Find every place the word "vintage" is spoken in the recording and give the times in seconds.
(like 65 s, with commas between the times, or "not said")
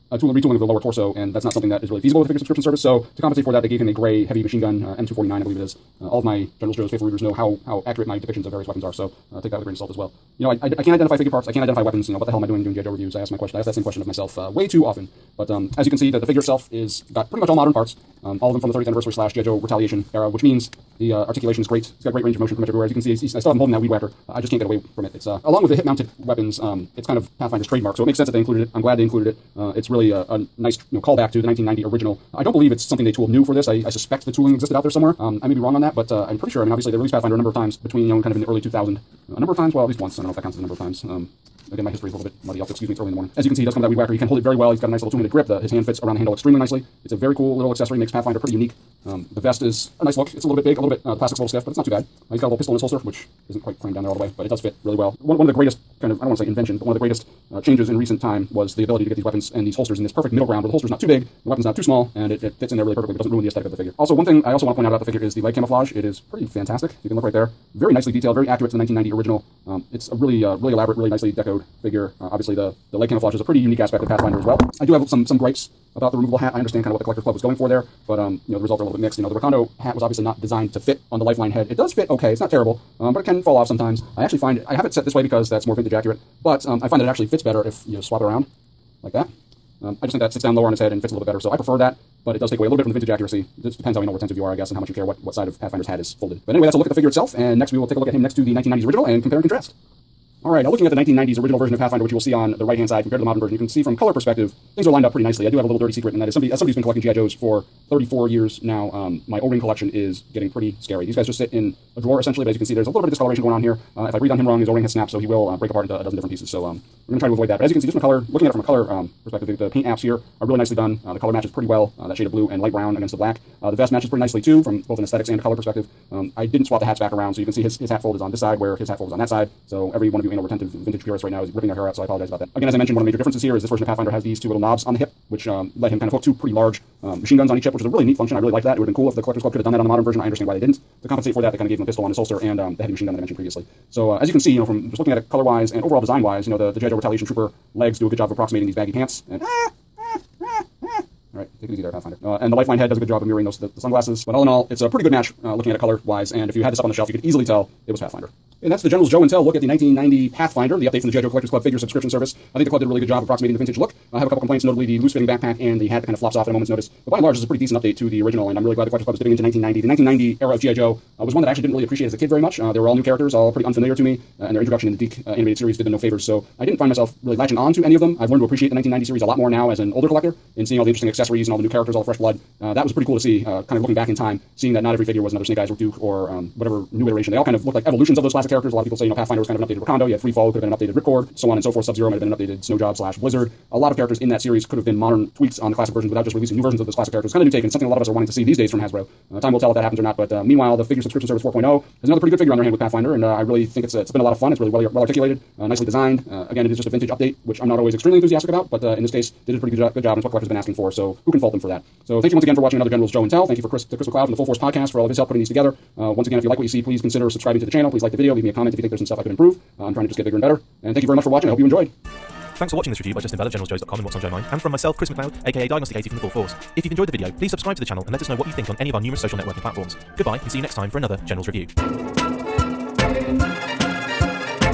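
85 s, 92 s, 130 s, 163 s, 206 s.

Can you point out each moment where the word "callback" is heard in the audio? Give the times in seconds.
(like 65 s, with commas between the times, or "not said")
31 s.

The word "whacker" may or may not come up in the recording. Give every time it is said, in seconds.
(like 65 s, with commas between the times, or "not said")
23 s, 43 s.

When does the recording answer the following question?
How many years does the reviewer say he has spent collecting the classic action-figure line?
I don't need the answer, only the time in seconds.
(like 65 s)
107 s.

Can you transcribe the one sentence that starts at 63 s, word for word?
Also, one thing I also want to point out about the figure is the leg camouflage.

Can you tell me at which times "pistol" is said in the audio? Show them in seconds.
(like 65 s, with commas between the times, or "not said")
52 s, 141 s.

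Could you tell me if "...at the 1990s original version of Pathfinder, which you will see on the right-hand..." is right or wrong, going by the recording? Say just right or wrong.
right.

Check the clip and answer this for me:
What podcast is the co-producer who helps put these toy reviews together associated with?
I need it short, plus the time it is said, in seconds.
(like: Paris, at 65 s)
Full Force Podcast, at 214 s.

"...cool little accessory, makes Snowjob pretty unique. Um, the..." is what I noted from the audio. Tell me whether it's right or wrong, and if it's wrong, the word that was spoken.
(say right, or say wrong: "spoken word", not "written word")
wrong: "Pathfinder", not "Snowjob".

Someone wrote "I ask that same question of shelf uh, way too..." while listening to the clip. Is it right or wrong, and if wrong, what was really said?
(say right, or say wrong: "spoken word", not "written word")
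wrong: "myself", not "shelf".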